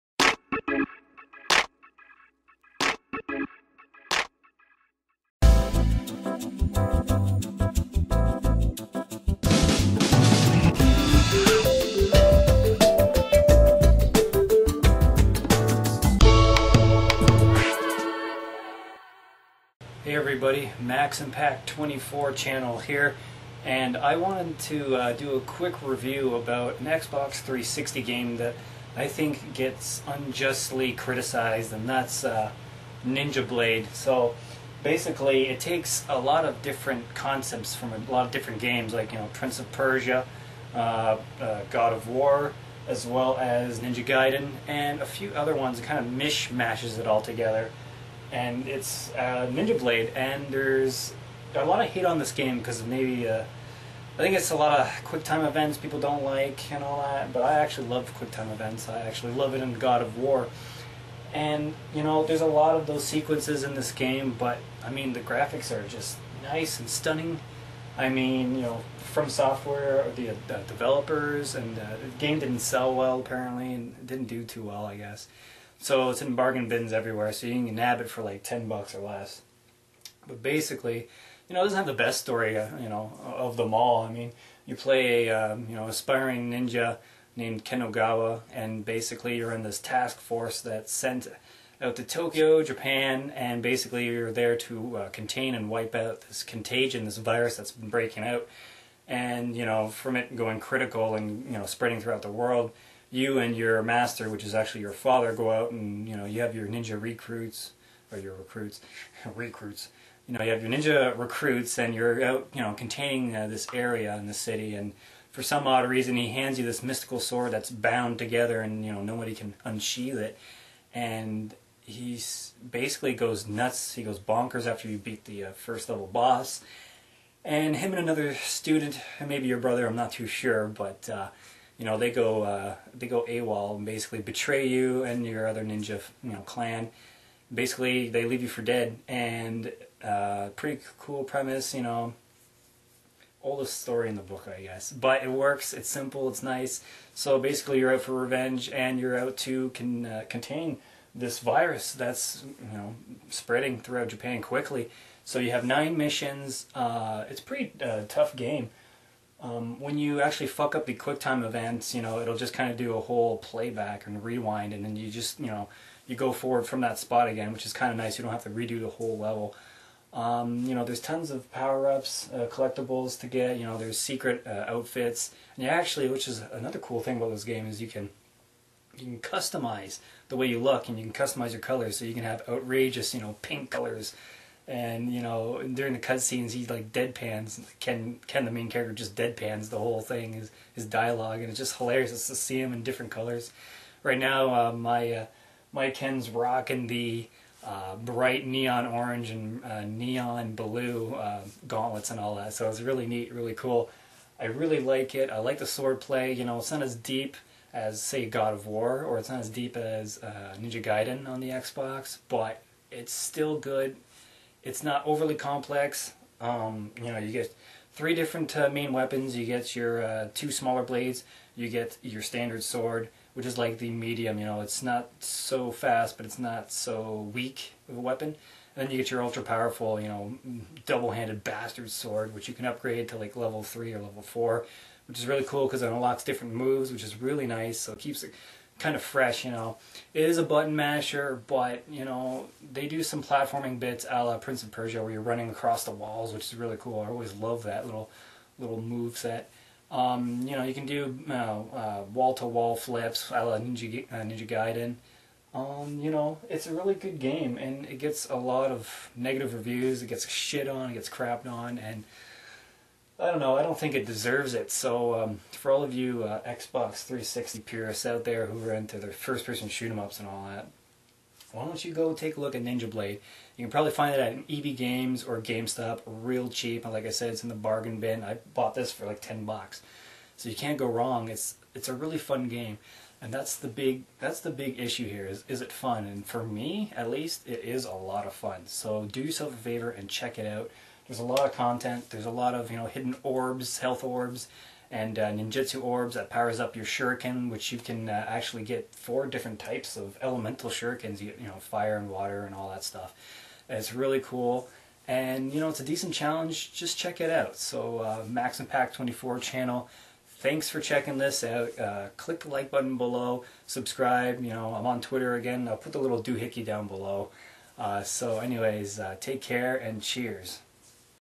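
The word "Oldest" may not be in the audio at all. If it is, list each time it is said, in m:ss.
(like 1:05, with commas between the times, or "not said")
2:23.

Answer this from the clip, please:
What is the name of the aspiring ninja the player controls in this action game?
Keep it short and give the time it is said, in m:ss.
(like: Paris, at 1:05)
Ken Ogawa, at 1:27.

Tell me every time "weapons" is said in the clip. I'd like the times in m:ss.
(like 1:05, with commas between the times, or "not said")
3:38, 3:48.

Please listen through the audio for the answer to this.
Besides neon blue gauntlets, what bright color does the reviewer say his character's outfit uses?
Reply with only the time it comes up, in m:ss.
3:17.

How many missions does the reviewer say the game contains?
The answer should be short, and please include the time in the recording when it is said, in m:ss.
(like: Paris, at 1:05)
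9, at 2:35.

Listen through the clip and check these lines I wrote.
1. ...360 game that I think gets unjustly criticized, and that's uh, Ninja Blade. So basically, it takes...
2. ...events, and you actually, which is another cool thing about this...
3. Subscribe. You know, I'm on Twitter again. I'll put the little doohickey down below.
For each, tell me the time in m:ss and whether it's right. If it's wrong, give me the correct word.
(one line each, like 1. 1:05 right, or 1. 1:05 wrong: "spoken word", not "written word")
1. 0:27 right
2. 2:54 wrong: "outfits", not "events"
3. 5:13 right.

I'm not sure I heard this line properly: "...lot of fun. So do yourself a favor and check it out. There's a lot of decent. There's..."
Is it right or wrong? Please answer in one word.
wrong.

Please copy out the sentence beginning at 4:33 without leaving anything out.
You can probably find it at EB Games or GameStop, real cheap.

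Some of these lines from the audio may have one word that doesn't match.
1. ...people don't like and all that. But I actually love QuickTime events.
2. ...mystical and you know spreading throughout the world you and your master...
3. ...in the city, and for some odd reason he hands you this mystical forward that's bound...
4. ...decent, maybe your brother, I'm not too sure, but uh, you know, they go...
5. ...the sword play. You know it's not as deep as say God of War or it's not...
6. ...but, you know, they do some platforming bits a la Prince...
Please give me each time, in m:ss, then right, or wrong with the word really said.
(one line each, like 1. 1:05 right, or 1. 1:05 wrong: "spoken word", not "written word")
1. 0:55 right
2. 1:40 wrong: "critical", not "mystical"
3. 1:54 wrong: "sword", not "forward"
4. 2:08 wrong: "student", not "decent"
5. 3:25 right
6. 4:01 right.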